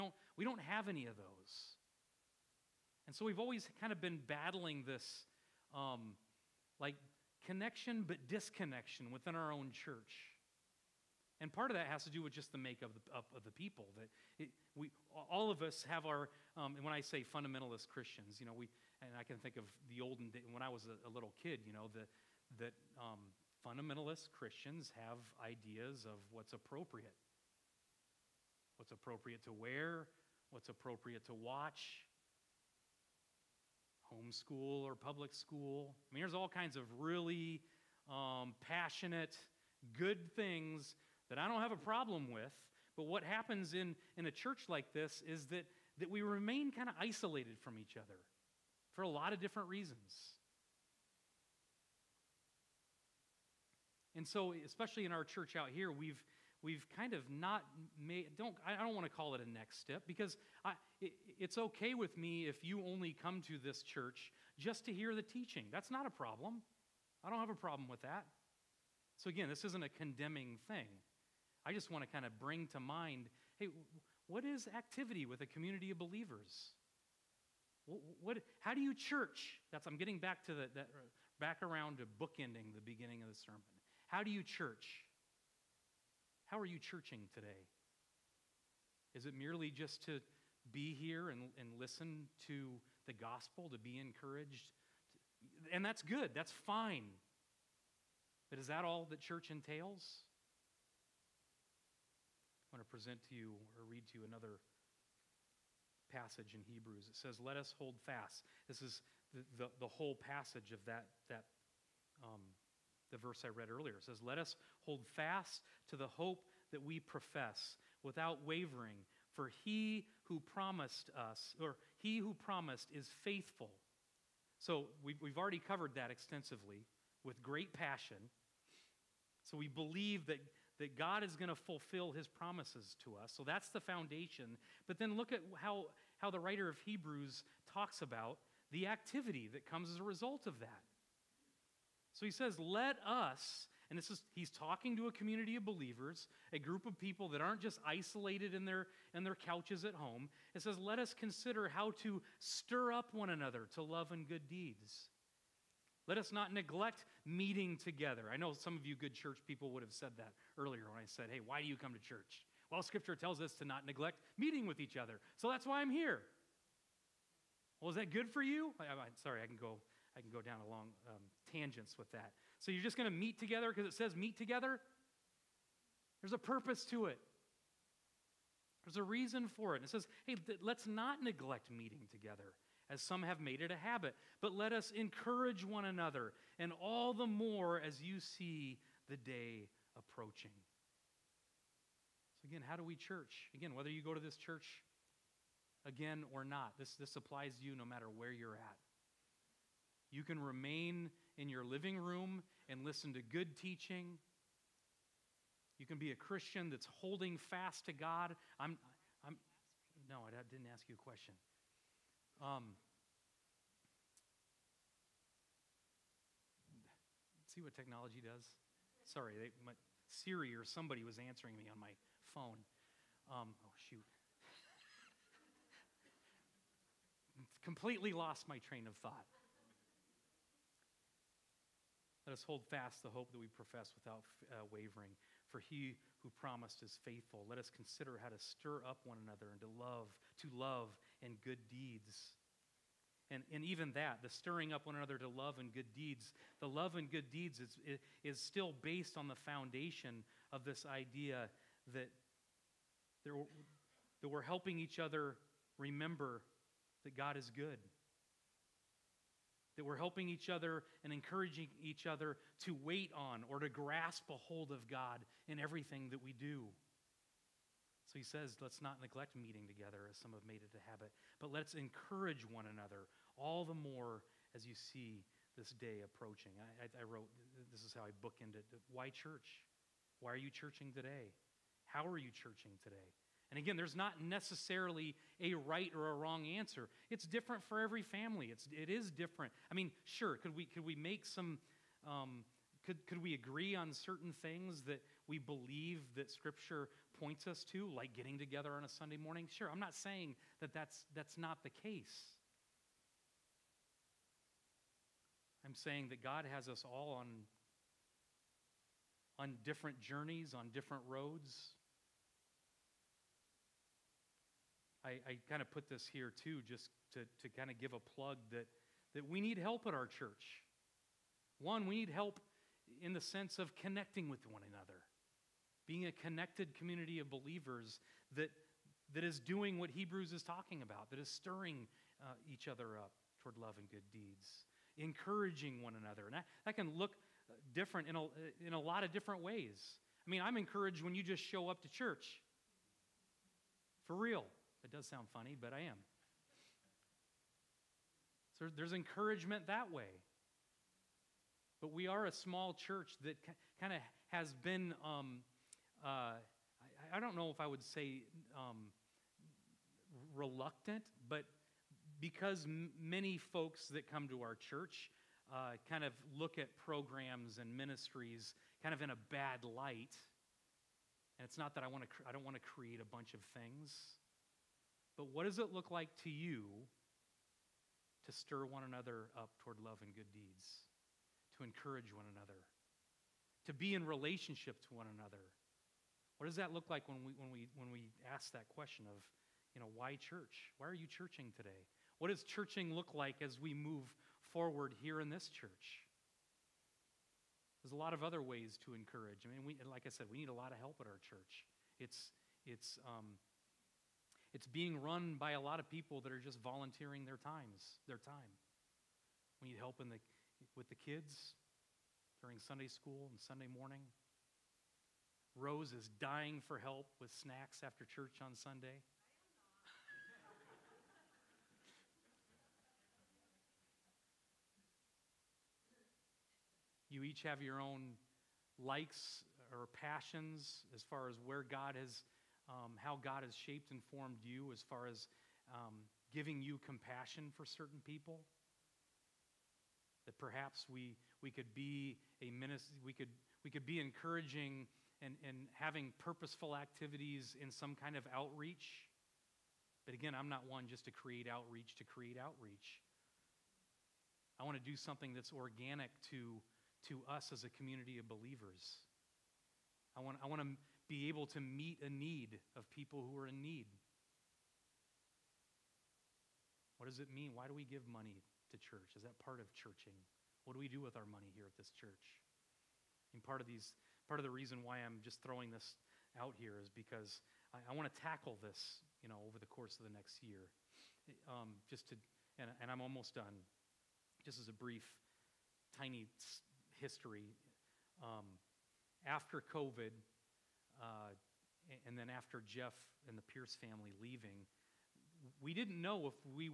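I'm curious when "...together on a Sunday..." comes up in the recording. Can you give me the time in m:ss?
4:58.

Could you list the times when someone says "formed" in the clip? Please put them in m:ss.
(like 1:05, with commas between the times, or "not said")
7:14.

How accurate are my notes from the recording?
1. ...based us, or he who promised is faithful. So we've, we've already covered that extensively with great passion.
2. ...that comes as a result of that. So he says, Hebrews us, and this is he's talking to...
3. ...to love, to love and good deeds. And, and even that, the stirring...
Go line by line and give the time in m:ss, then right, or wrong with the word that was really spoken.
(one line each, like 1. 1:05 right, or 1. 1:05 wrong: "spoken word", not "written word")
1. 2:00 wrong: "promised", not "based"
2. 2:19 wrong: "Let", not "Hebrews"
3. 3:59 right.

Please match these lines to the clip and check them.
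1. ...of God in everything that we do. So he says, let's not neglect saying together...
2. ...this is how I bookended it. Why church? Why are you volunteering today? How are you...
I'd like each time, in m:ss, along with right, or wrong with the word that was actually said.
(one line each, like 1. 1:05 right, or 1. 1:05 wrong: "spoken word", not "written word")
1. 4:24 wrong: "meeting", not "saying"
2. 4:37 wrong: "churching", not "volunteering".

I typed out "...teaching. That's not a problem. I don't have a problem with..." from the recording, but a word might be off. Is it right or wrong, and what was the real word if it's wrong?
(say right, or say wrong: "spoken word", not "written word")
right.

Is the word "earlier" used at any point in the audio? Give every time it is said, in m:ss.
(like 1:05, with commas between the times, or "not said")
1:53, 2:40.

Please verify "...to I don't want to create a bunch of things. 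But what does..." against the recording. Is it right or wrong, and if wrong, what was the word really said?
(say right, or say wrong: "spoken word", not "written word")
right.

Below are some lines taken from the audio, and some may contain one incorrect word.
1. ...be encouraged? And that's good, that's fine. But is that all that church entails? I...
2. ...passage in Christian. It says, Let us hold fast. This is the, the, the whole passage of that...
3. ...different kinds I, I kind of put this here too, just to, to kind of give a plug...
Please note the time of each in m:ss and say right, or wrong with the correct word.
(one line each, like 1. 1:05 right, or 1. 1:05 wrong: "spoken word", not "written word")
1. 1:33 right
2. 1:46 wrong: "Hebrews", not "Christian"
3. 5:10 wrong: "roads", not "kinds".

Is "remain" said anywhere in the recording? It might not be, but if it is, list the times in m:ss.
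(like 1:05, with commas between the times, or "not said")
0:46, 3:20.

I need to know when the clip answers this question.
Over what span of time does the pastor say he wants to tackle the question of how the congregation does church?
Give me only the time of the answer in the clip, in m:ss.
8:00.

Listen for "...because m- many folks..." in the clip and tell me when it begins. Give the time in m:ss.
6:02.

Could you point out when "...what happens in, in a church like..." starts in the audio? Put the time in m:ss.
0:43.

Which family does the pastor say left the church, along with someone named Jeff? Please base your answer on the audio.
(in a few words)
the Pierce family.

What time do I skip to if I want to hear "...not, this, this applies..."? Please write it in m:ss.
3:16.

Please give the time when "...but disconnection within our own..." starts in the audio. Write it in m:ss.
0:08.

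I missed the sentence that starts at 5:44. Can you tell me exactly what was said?
It does sound funny, but I am.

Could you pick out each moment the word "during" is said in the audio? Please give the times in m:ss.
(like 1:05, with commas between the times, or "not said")
6:52.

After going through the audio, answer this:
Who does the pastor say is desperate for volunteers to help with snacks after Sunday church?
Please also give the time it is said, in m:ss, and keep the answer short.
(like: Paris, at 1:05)
Rose, at 6:55.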